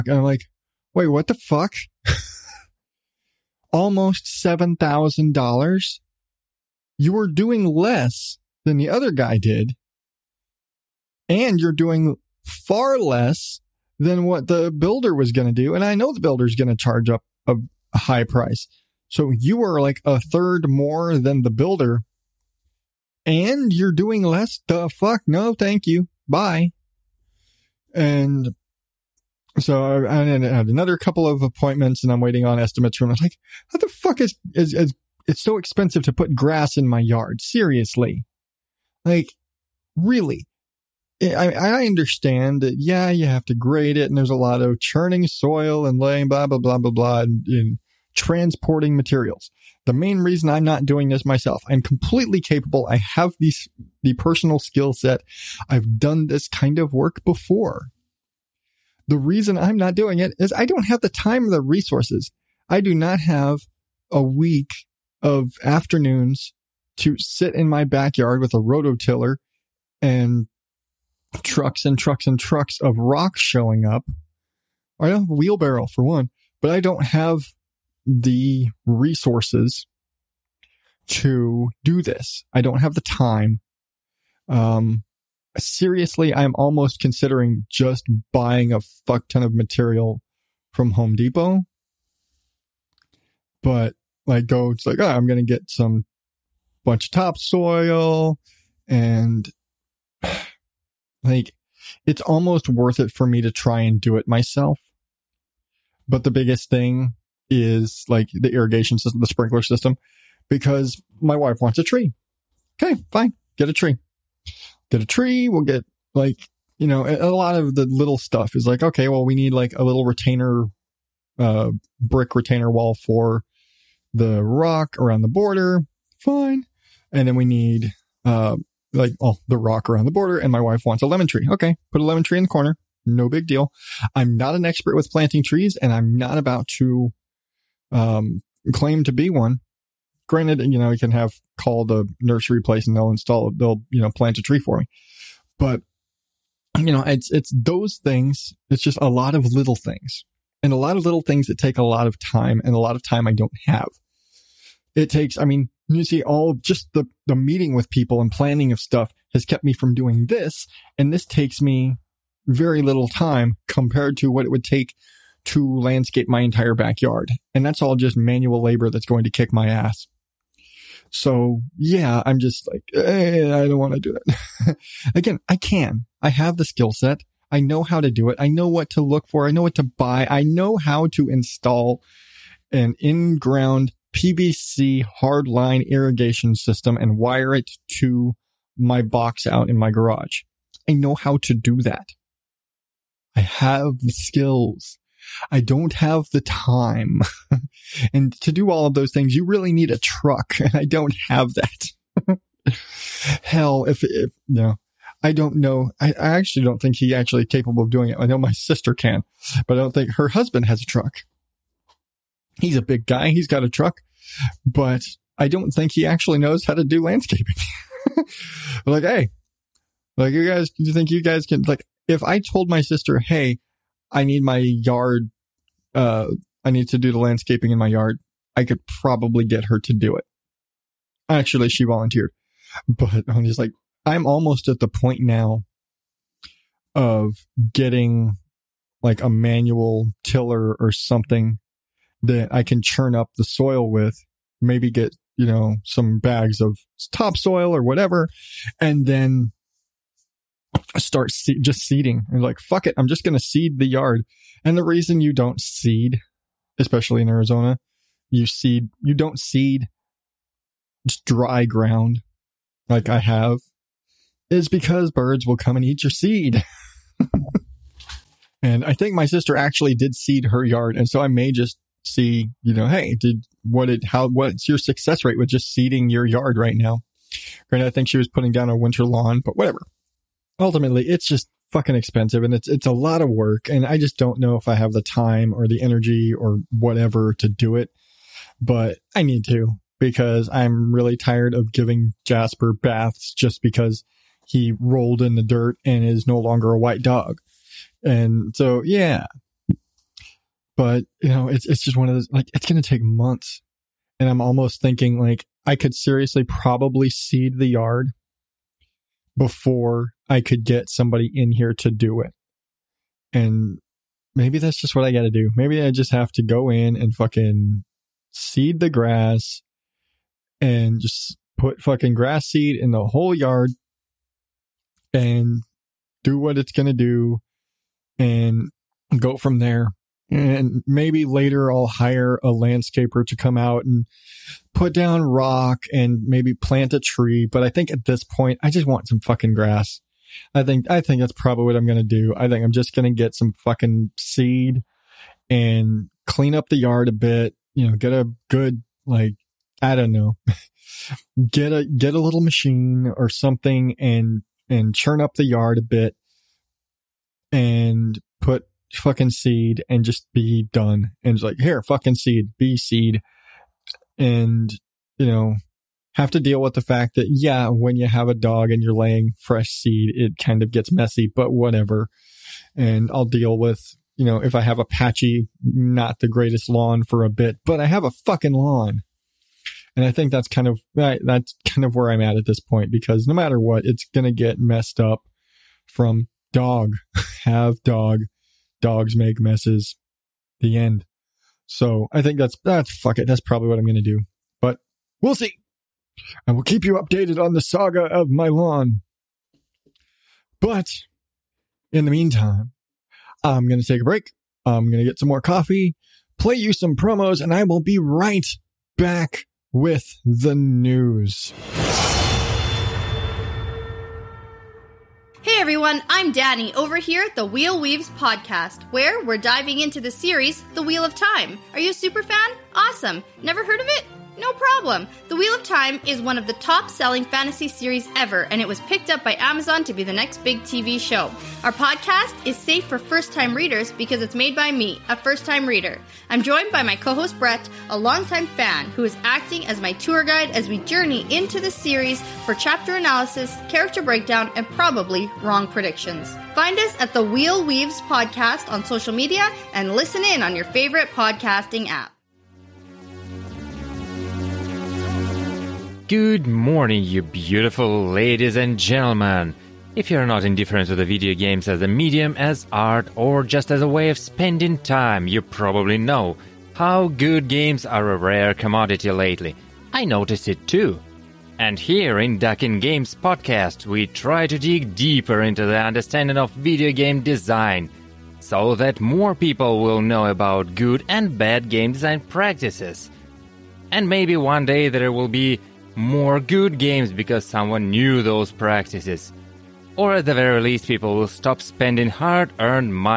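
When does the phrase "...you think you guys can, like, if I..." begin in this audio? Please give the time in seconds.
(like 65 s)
220 s.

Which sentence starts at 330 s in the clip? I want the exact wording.
And maybe later I'll hire a landscaper to come out and put down rock and maybe plant a tree.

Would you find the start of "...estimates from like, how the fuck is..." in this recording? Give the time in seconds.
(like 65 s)
32 s.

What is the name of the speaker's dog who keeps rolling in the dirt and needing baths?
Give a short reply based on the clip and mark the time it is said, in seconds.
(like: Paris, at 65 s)
Jasper, at 292 s.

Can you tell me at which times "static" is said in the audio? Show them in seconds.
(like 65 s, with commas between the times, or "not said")
not said.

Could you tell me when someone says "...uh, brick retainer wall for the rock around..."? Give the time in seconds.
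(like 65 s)
121 s.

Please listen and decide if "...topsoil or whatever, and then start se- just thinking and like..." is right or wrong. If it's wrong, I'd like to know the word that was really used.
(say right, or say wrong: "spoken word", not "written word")
wrong: "seeding", not "thinking".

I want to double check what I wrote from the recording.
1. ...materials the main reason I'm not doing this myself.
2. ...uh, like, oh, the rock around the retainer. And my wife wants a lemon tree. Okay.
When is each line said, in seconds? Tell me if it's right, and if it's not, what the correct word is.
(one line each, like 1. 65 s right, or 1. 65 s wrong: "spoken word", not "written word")
1. 48 s right
2. 128 s wrong: "border", not "retainer".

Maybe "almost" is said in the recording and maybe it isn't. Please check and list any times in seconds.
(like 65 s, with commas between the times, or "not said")
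3 s, 86 s, 102 s, 234 s, 304 s.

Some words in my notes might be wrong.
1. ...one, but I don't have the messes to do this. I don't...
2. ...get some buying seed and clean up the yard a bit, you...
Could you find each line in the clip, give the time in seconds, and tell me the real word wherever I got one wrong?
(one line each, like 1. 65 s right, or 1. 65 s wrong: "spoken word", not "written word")
1. 76 s wrong: "resources", not "messes"
2. 343 s wrong: "fucking", not "buying".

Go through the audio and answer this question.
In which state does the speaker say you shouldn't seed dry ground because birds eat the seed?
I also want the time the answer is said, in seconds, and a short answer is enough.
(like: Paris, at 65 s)
Arizona, at 257 s.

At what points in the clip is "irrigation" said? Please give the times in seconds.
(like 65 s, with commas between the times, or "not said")
108 s, 185 s.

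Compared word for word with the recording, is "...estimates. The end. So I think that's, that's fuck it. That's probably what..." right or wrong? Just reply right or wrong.
wrong.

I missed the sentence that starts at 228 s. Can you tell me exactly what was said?
I could probably get her to do it.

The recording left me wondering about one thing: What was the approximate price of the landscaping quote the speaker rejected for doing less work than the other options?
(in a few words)
$7,000.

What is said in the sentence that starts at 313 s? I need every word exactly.
And maybe that's just what I got to do.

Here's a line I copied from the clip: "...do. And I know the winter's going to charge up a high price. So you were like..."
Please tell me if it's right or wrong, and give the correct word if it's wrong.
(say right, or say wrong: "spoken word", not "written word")
wrong: "builder", not "winter".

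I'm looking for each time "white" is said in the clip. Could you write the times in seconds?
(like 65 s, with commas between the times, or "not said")
296 s.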